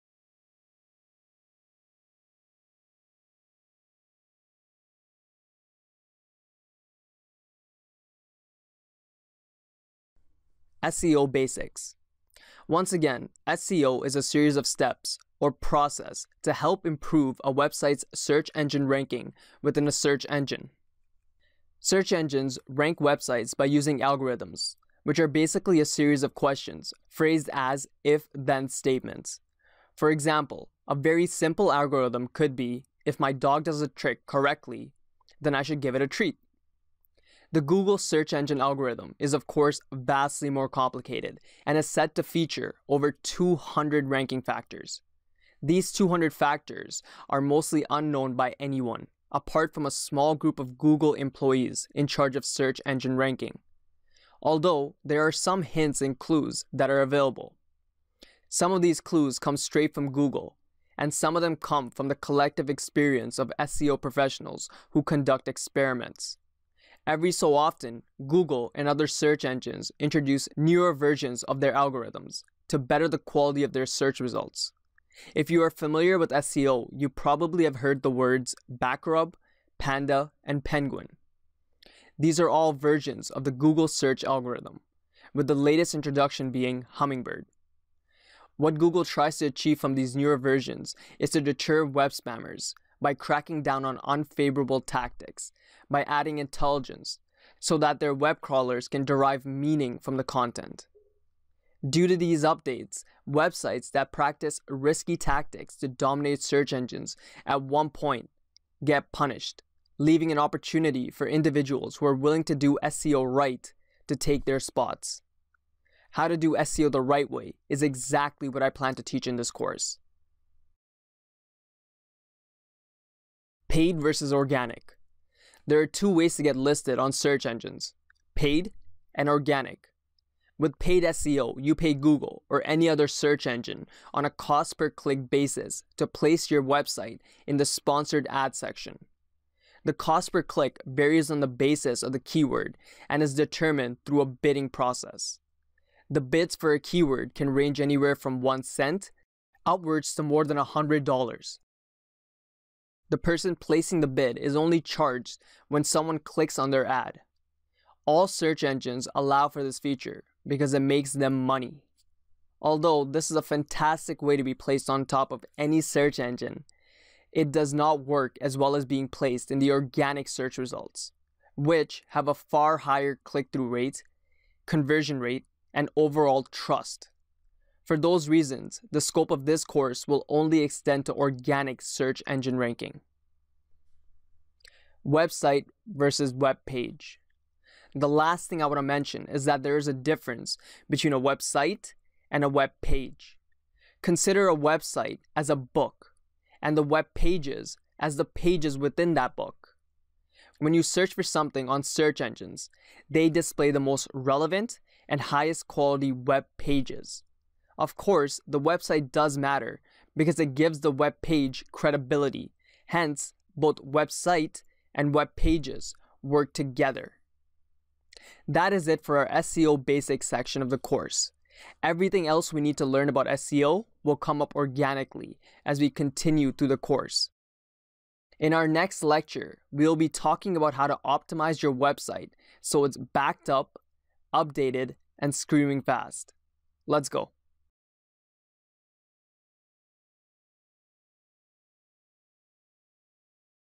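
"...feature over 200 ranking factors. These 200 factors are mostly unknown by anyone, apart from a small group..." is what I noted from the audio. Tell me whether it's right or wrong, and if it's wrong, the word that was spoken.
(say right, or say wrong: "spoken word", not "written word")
right.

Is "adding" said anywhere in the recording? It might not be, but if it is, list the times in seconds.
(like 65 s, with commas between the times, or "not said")
96 s.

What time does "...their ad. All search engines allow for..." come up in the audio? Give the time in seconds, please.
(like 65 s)
156 s.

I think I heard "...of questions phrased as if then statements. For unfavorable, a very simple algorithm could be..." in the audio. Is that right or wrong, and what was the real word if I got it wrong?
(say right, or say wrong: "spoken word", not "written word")
wrong: "example", not "unfavorable".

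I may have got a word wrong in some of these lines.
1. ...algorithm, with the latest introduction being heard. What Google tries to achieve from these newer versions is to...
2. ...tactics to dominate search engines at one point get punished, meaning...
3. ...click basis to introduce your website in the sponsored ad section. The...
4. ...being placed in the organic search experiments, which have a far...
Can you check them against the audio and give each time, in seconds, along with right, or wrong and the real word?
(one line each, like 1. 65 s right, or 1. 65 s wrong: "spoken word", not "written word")
1. 84 s wrong: "hummingbird", not "heard"
2. 105 s wrong: "leaving", not "meaning"
3. 134 s wrong: "place", not "introduce"
4. 168 s wrong: "results", not "experiments".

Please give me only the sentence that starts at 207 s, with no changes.
Of course, the website does matter because it gives the web page credibility.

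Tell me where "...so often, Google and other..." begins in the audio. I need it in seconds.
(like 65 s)
67 s.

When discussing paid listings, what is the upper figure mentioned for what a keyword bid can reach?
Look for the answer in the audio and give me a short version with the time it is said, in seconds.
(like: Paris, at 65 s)
more than $100, at 150 s.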